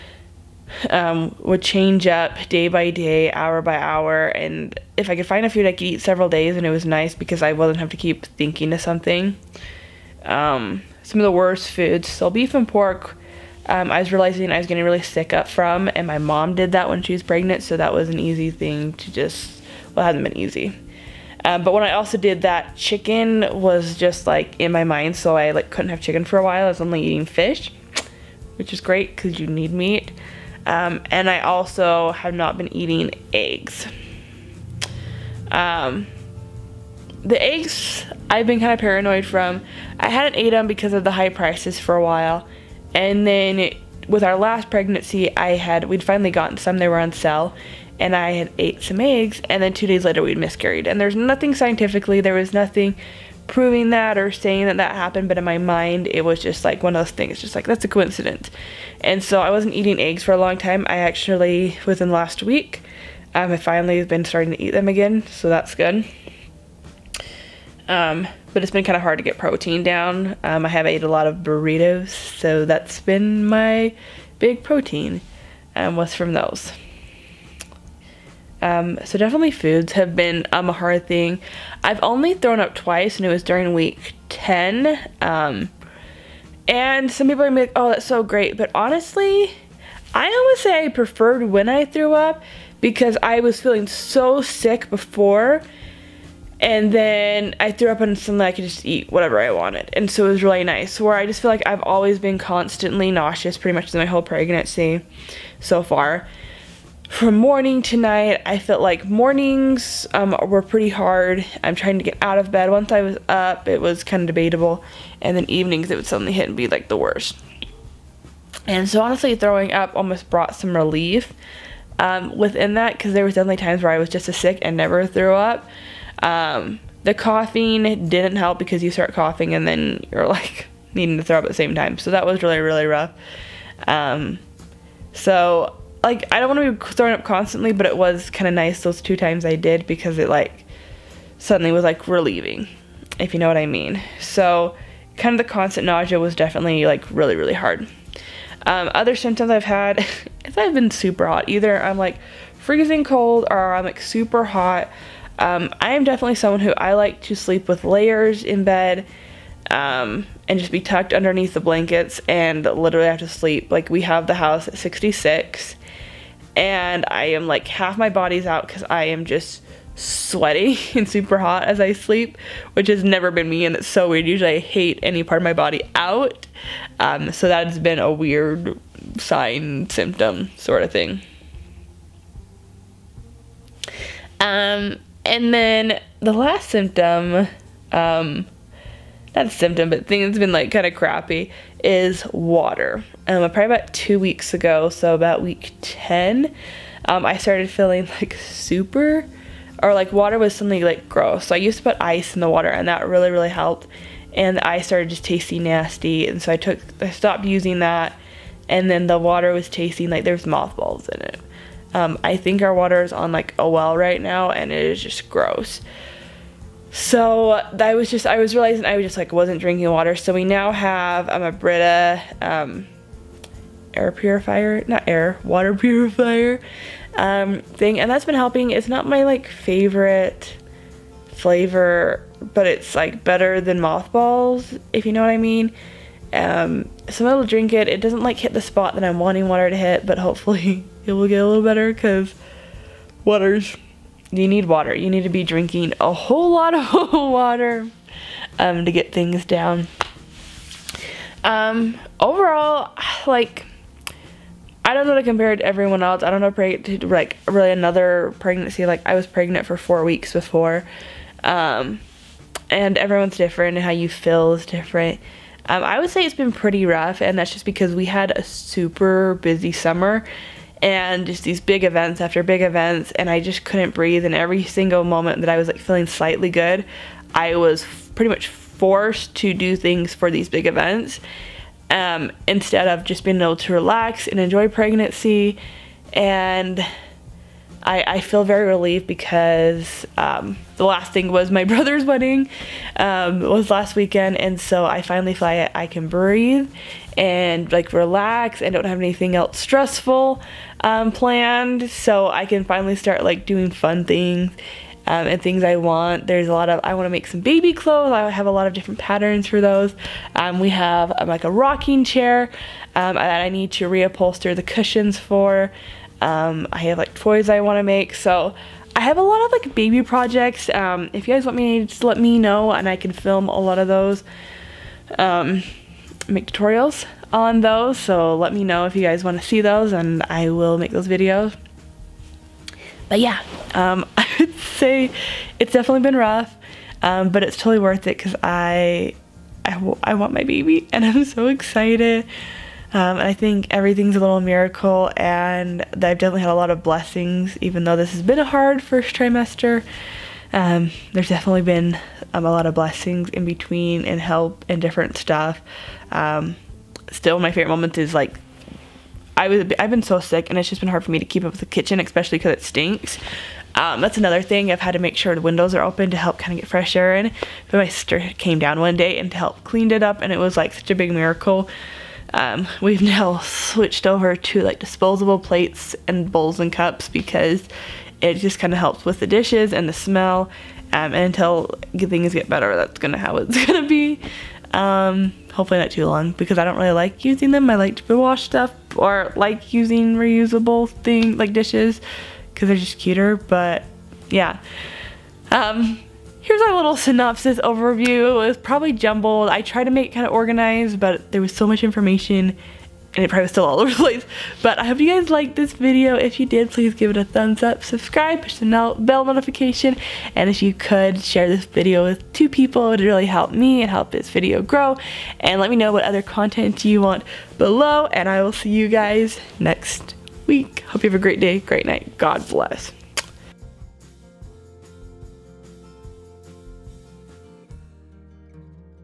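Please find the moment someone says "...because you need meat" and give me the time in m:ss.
0:29.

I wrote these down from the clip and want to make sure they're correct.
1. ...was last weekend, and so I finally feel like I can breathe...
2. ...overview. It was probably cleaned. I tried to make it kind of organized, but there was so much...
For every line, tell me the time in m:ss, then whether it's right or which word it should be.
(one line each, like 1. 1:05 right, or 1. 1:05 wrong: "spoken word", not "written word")
1. 4:53 right
2. 6:37 wrong: "jumbled", not "cleaned".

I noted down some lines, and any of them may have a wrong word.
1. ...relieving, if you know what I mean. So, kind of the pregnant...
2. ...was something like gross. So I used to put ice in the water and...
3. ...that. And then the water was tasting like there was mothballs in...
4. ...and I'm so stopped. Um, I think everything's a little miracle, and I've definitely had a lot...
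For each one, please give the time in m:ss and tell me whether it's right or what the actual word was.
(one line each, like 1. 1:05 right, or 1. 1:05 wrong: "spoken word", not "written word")
1. 2:22 wrong: "constant", not "pregnant"
2. 3:20 right
3. 3:27 right
4. 5:40 wrong: "excited", not "stopped".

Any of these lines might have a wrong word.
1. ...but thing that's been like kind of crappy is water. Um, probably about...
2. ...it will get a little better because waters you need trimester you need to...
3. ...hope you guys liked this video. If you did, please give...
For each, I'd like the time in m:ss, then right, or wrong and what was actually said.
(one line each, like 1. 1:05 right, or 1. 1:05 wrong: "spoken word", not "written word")
1. 3:09 right
2. 4:01 wrong: "water", not "trimester"
3. 6:44 right.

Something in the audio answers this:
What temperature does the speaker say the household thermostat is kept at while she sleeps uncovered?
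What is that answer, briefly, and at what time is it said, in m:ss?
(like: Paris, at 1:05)
66, at 2:44.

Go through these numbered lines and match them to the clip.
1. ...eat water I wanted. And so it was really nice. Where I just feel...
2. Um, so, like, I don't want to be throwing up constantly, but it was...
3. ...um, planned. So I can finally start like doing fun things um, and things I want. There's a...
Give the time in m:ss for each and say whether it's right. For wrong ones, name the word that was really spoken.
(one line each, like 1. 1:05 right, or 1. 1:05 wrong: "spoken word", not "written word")
1. 1:38 wrong: "whatever", not "water"
2. 2:13 right
3. 5:00 right.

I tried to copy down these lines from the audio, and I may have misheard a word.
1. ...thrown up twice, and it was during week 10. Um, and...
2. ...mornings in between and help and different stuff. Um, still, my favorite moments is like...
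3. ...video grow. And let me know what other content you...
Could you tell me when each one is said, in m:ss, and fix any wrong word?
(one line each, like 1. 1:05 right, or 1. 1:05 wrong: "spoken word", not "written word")
1. 1:22 right
2. 5:52 wrong: "blessings", not "mornings"
3. 6:54 right.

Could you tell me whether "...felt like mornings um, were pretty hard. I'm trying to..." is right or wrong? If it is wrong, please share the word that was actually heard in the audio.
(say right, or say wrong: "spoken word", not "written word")
right.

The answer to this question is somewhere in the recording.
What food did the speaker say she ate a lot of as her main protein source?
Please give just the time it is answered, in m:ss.
1:11.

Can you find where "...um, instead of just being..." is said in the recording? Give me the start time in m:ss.
4:41.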